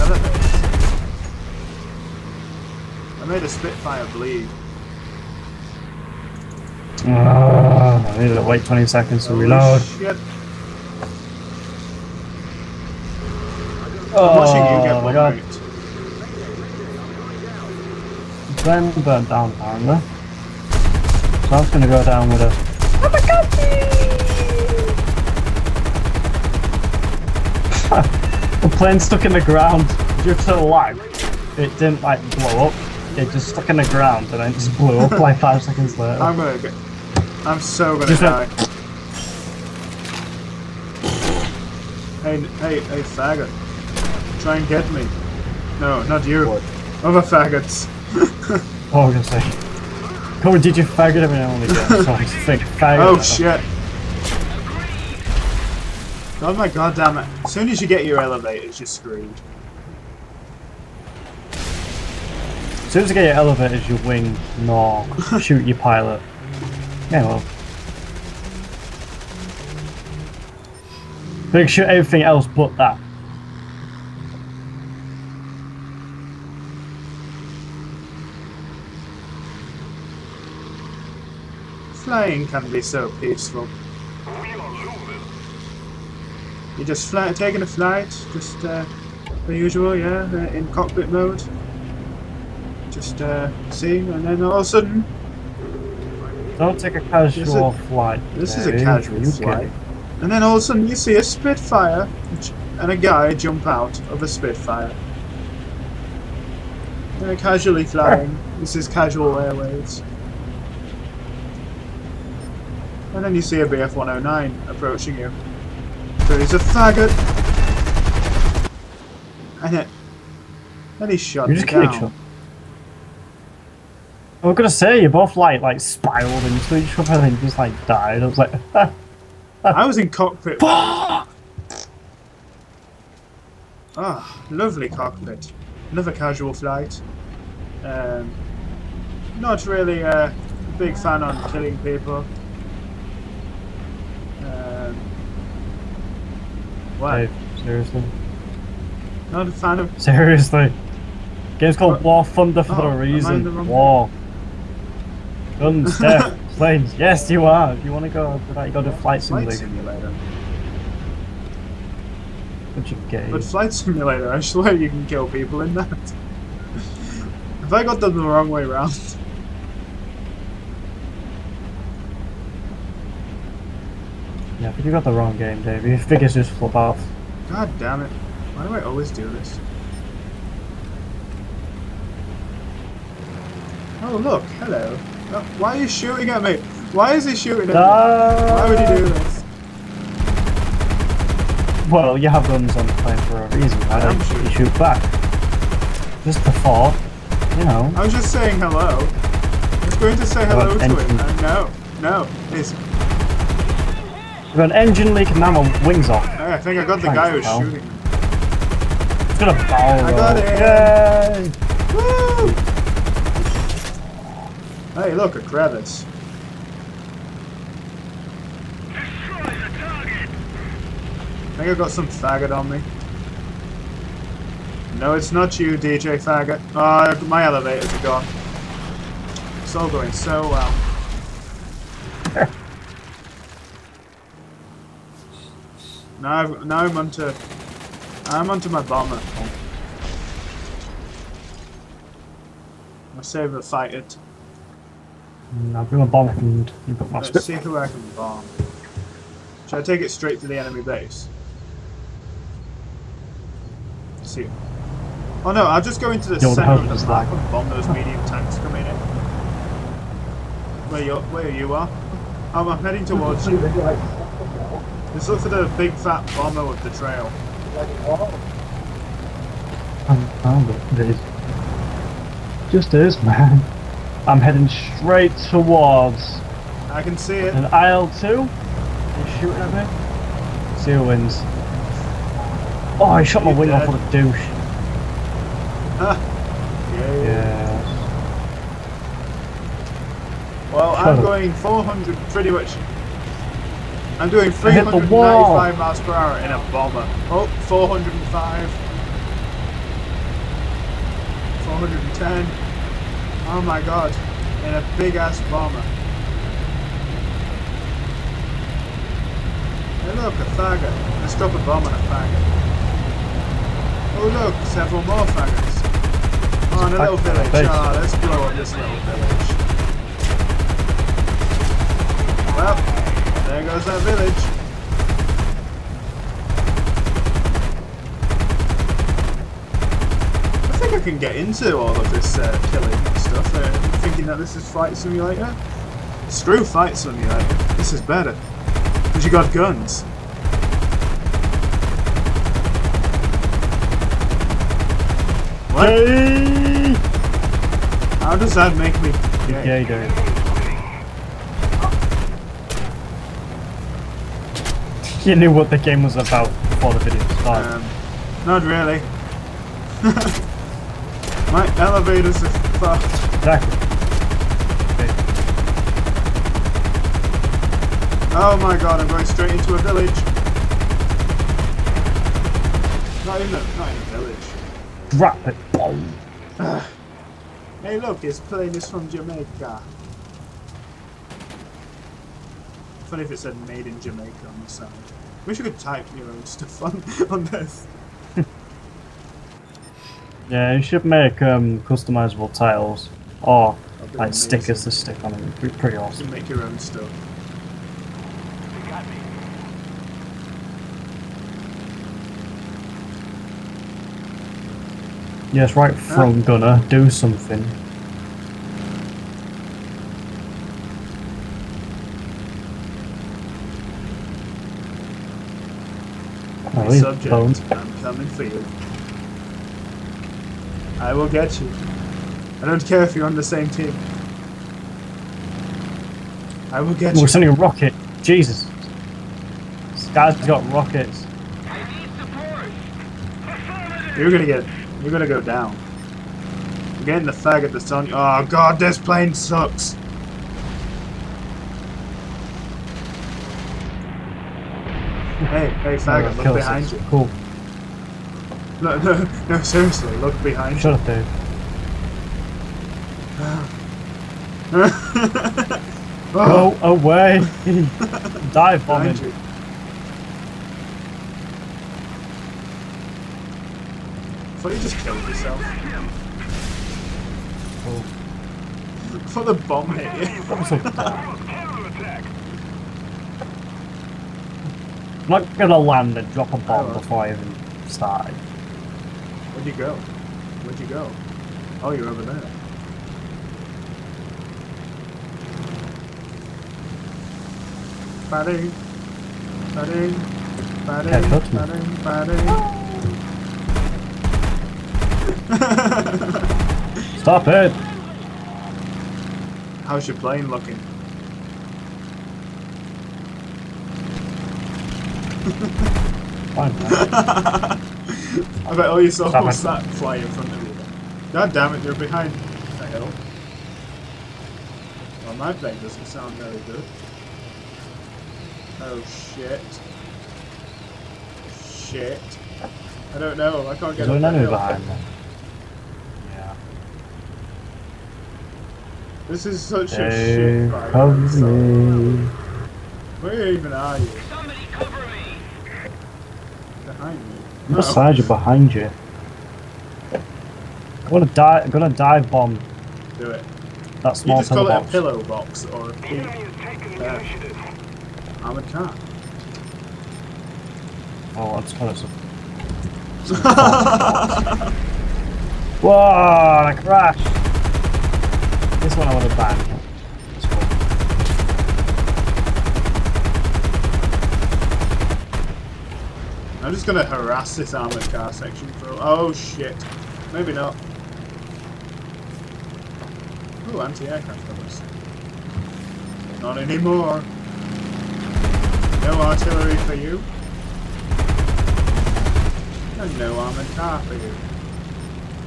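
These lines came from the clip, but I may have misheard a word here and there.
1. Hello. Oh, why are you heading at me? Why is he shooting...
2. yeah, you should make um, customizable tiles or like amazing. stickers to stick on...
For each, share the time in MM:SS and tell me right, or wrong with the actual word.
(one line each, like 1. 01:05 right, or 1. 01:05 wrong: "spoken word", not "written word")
1. 03:04 wrong: "shooting", not "heading"
2. 06:30 right.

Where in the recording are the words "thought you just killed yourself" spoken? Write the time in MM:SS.
07:44.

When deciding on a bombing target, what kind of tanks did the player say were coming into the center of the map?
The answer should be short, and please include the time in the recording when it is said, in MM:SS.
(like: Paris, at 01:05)
medium tanks, at 04:17.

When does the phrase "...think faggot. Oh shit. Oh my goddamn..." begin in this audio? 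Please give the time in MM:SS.
00:52.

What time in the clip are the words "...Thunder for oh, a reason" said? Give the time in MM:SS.
02:32.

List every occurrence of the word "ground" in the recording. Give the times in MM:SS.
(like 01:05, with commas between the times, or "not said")
00:29, 00:33.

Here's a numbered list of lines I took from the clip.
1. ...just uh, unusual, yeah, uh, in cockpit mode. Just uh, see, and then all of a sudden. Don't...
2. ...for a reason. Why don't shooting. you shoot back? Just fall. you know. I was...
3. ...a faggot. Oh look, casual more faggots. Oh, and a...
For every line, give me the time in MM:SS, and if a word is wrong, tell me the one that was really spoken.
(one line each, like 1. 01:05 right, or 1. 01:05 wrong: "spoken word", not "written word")
1. 01:28 right
2. 03:13 right
3. 05:11 wrong: "several", not "casual".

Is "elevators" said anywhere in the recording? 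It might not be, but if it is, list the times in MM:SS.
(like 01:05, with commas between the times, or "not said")
00:58, 01:03, 03:47, 06:01.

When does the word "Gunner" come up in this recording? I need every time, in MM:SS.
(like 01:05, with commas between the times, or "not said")
06:46.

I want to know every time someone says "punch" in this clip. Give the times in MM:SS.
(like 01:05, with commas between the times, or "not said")
not said.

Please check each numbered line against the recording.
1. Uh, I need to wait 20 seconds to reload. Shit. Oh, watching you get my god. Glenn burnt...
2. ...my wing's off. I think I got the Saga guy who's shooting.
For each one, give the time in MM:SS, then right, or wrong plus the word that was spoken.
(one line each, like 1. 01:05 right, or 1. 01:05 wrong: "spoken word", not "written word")
1. 00:07 right
2. 03:25 wrong: "Thanks", not "Saga".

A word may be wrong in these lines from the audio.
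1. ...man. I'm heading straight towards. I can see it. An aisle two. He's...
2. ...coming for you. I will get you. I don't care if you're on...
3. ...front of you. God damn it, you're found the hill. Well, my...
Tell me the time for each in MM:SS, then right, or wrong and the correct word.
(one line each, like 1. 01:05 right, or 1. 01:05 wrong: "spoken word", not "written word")
1. 04:33 right
2. 06:58 right
3. 08:30 wrong: "behind", not "found".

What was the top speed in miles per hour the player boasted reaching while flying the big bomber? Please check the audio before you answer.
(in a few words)
410.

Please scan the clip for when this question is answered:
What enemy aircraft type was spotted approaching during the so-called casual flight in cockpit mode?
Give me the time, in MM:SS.
01:53.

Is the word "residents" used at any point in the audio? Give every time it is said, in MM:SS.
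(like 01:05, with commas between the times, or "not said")
not said.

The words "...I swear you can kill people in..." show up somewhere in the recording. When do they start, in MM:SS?
02:44.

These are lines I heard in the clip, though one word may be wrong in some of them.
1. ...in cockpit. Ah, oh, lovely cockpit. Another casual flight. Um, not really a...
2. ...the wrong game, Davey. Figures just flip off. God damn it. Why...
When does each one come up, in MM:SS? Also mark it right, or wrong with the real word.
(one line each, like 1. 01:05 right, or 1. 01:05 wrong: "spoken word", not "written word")
1. 02:09 right
2. 02:55 right.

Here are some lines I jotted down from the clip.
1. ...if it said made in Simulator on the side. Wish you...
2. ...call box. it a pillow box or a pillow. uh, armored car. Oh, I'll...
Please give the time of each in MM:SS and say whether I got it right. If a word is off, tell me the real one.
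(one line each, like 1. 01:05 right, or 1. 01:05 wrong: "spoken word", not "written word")
1. 06:23 wrong: "Jamaica", not "Simulator"
2. 09:04 right.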